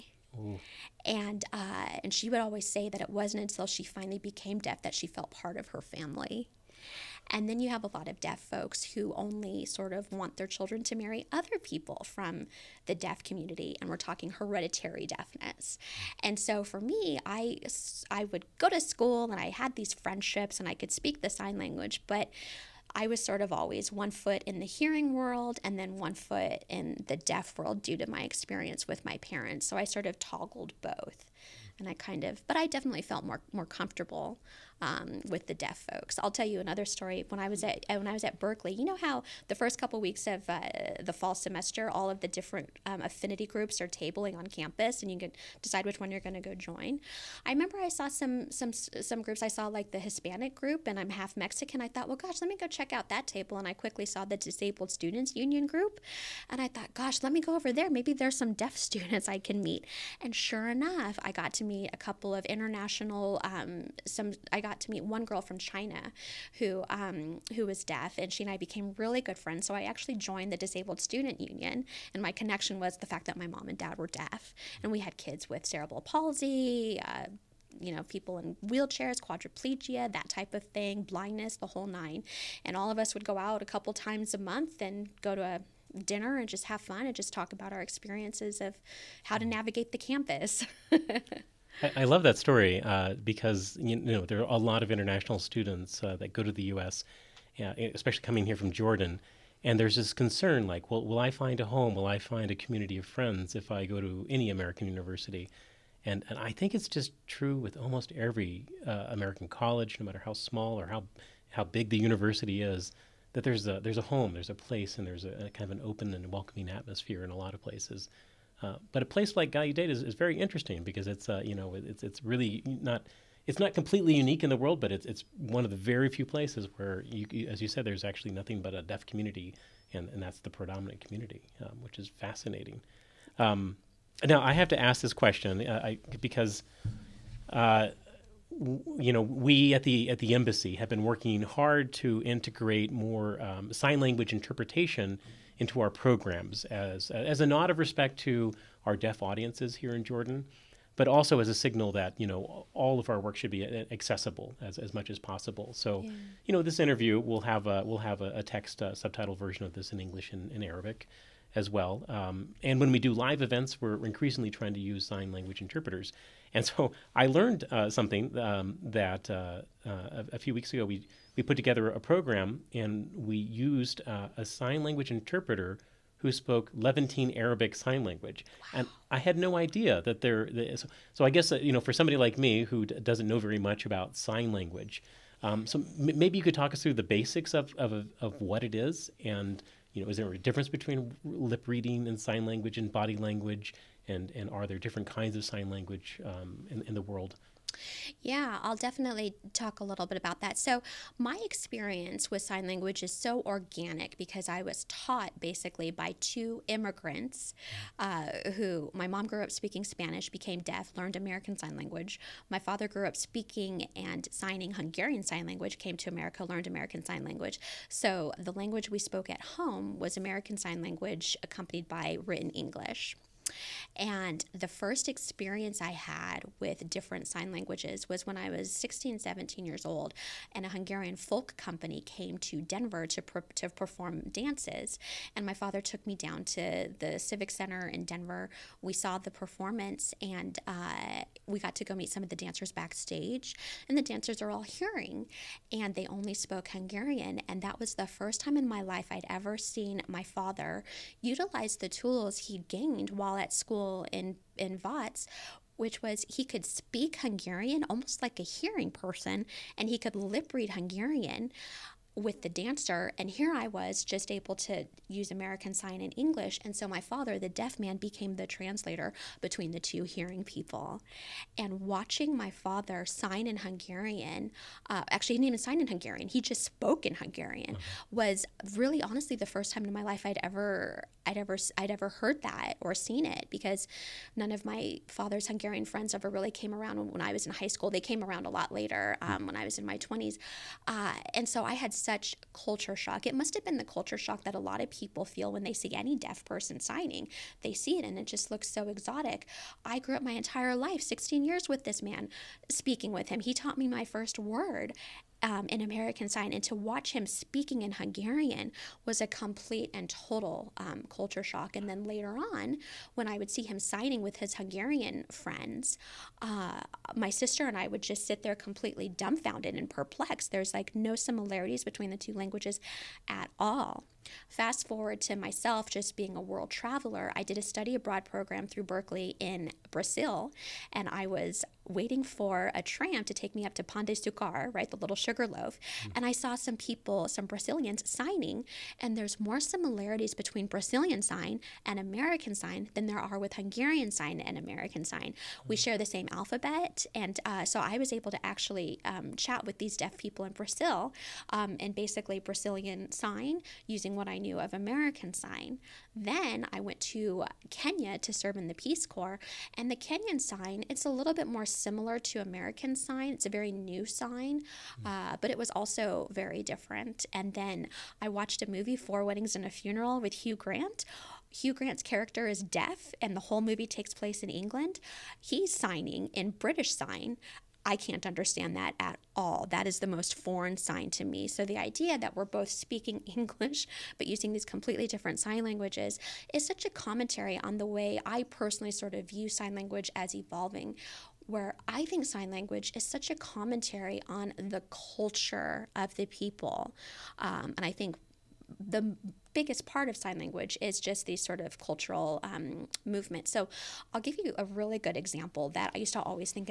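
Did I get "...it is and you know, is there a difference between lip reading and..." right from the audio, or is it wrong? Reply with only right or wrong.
right.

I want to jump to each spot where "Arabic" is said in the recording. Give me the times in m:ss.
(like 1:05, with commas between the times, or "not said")
2:40, 2:57.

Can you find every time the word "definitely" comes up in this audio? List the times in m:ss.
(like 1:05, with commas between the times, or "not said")
0:32, 3:18.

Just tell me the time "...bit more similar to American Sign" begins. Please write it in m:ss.
6:01.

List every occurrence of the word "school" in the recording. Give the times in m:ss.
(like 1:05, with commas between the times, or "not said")
0:18, 4:13, 4:47.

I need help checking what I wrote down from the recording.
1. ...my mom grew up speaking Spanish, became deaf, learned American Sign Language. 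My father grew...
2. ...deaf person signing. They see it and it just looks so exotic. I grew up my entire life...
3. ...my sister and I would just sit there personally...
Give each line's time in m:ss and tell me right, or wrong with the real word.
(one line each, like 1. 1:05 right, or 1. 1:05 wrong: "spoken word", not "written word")
1. 3:28 right
2. 4:56 right
3. 5:17 wrong: "completely", not "personally".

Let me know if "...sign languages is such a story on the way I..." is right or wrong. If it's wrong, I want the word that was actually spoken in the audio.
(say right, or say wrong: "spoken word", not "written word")
wrong: "commentary", not "story".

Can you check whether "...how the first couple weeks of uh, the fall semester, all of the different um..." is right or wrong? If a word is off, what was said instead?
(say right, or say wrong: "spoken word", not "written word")
right.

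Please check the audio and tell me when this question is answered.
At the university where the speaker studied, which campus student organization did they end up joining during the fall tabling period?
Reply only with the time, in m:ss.
1:10.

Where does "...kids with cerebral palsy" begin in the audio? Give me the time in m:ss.
1:15.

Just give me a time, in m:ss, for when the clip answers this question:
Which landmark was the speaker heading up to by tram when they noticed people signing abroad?
5:33.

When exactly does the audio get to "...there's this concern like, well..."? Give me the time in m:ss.
1:39.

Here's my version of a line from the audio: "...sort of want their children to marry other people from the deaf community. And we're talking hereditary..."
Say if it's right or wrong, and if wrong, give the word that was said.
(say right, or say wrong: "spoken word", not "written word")
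right.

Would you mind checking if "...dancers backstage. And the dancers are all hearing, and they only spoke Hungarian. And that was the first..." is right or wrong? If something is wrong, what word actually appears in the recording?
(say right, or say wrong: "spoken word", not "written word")
right.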